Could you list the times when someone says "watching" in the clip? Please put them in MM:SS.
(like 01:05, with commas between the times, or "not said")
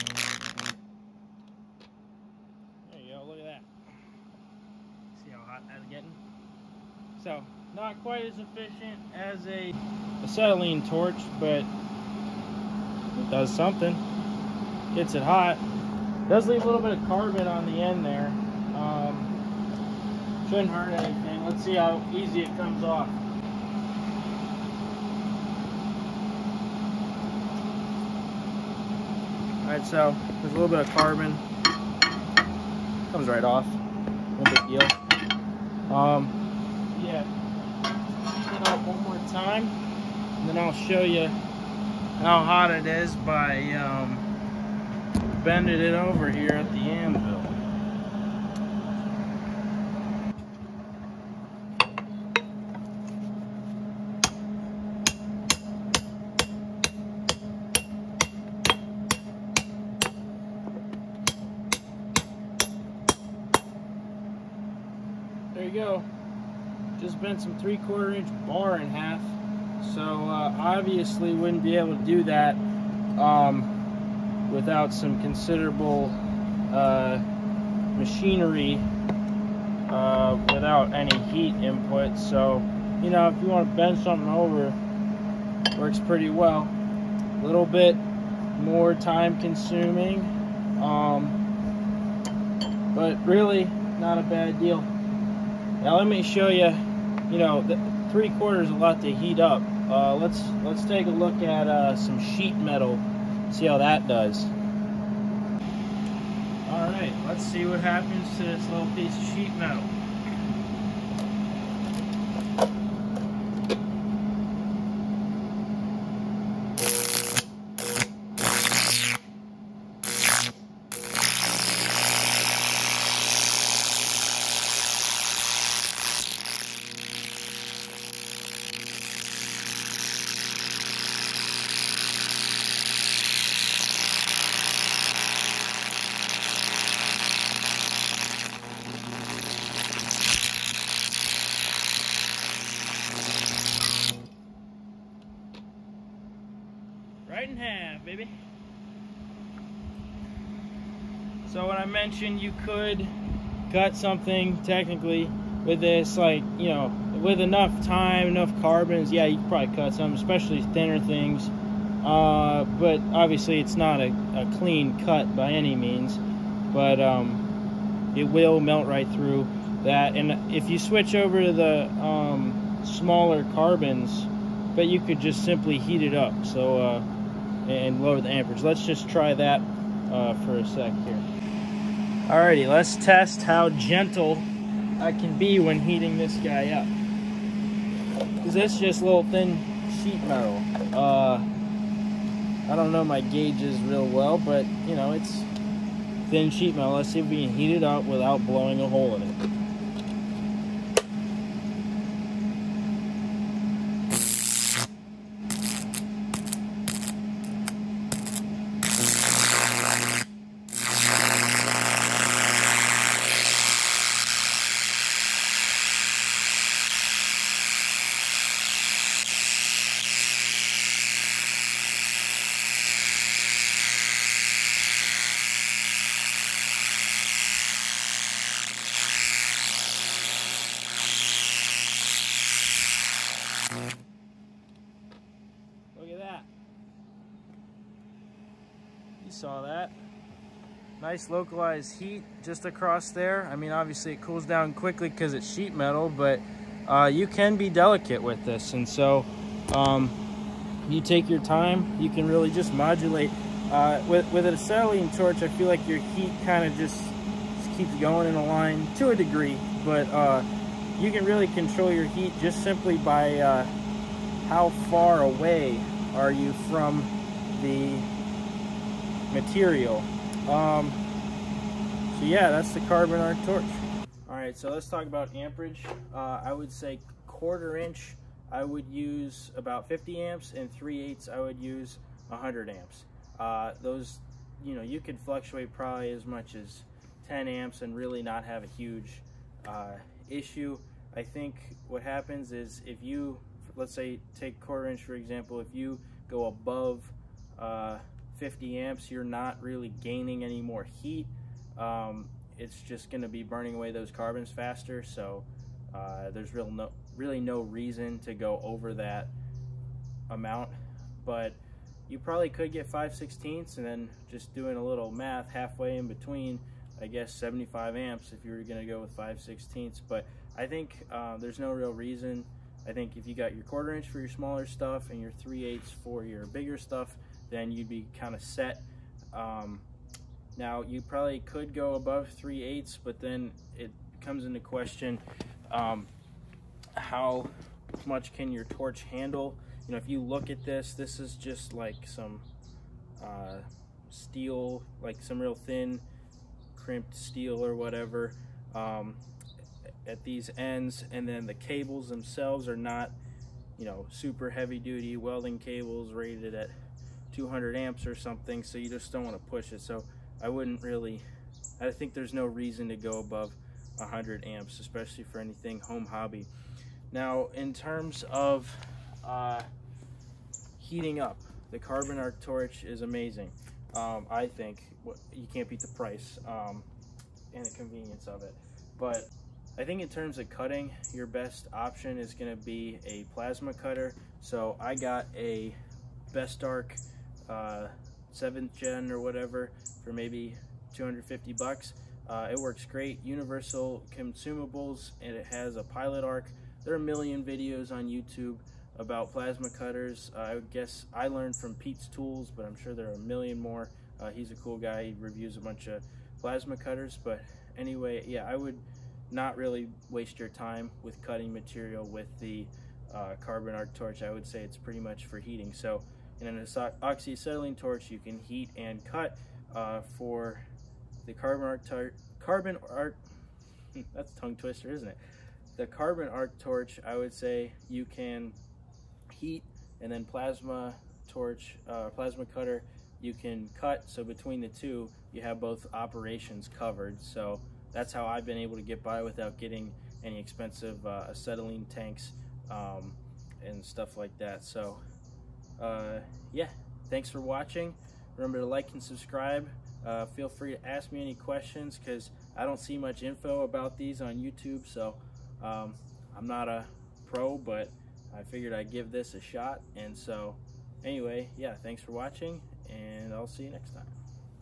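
07:27, 07:42.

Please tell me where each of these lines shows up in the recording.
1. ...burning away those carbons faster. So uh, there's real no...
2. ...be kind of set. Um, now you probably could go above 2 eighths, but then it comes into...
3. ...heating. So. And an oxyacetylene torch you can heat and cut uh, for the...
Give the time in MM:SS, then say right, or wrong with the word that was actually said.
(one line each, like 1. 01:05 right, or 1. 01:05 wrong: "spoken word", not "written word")
1. 05:03 right
2. 05:27 wrong: "3", not "2"
3. 06:55 right.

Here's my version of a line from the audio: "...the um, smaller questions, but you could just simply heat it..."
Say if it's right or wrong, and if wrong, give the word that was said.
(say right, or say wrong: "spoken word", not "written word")
wrong: "carbons", not "questions".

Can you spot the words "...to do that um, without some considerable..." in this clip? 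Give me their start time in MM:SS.
01:11.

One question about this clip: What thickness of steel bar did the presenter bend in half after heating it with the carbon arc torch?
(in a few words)
3/4 inch.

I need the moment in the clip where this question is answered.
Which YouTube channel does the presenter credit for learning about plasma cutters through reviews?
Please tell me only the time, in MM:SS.
06:41.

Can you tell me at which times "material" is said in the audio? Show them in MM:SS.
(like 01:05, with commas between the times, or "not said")
04:29, 06:51.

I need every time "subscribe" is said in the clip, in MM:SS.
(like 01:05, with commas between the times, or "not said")
07:29.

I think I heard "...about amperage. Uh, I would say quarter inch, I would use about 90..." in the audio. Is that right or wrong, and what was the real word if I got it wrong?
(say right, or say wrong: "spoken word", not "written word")
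wrong: "50", not "90".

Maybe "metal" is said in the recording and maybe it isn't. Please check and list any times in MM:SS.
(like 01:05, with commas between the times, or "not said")
01:42, 01:49, 03:10, 03:16, 04:05.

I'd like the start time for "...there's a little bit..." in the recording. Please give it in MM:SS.
00:30.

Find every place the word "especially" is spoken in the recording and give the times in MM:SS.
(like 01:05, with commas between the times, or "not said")
02:40, 06:04.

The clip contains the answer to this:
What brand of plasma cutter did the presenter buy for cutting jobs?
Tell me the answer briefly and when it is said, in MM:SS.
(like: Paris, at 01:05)
Best Arc, at 06:26.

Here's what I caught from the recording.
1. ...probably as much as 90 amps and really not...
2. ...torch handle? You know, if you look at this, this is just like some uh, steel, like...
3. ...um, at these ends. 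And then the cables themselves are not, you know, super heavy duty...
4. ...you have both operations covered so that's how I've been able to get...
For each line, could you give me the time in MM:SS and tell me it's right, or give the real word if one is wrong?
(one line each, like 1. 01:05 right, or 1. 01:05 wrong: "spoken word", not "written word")
1. 04:45 wrong: "10", not "90"
2. 05:38 right
3. 05:48 right
4. 07:15 right.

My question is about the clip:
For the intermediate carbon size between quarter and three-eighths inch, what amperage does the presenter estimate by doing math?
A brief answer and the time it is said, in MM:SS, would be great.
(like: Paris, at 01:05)
75 amps, at 05:17.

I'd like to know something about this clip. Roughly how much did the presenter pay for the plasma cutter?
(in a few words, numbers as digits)
$250.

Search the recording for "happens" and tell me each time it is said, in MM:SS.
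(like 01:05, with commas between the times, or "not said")
01:47, 04:52.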